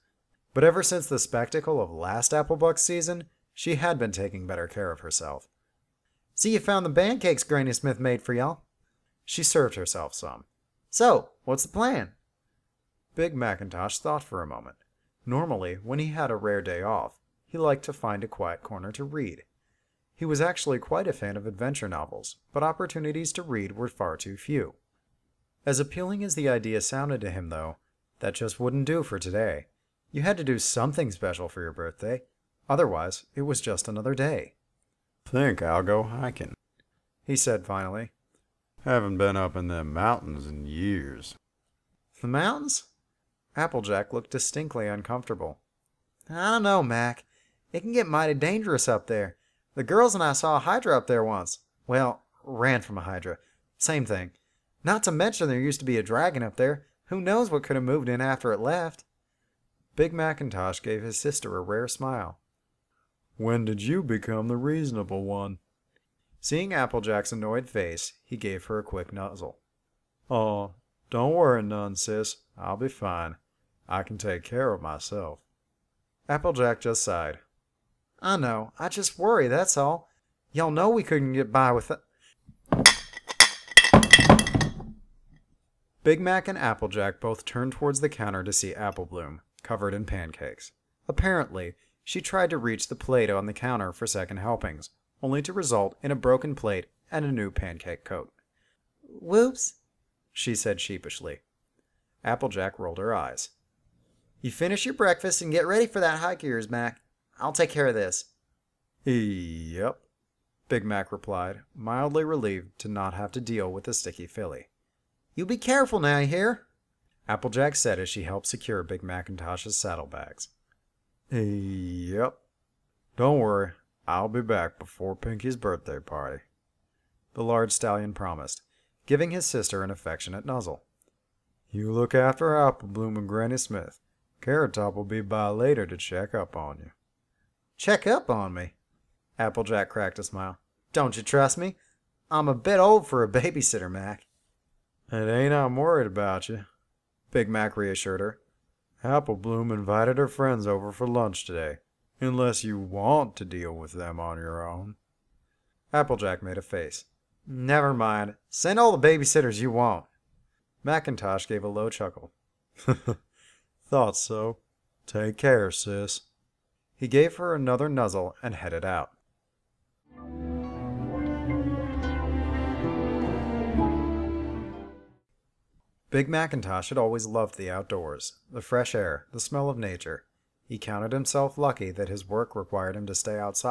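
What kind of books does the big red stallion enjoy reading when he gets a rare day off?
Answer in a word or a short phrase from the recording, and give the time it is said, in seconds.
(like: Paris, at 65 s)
Adventure novels, at 21 s.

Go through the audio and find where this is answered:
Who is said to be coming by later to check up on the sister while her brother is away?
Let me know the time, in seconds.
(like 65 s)
134 s.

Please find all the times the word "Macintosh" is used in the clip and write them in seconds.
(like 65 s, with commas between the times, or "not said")
13 s, 60 s, 119 s, 160 s, 176 s.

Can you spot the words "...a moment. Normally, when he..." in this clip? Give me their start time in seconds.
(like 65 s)
14 s.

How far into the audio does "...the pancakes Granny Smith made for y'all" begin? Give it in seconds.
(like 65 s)
6 s.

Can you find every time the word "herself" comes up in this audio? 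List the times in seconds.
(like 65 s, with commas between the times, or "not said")
4 s, 9 s.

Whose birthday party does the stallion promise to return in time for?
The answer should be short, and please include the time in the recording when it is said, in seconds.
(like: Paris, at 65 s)
Pinkie's, at 125 s.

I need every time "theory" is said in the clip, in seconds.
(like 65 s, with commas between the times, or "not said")
not said.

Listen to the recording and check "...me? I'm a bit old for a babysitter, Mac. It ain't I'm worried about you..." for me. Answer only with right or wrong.
right.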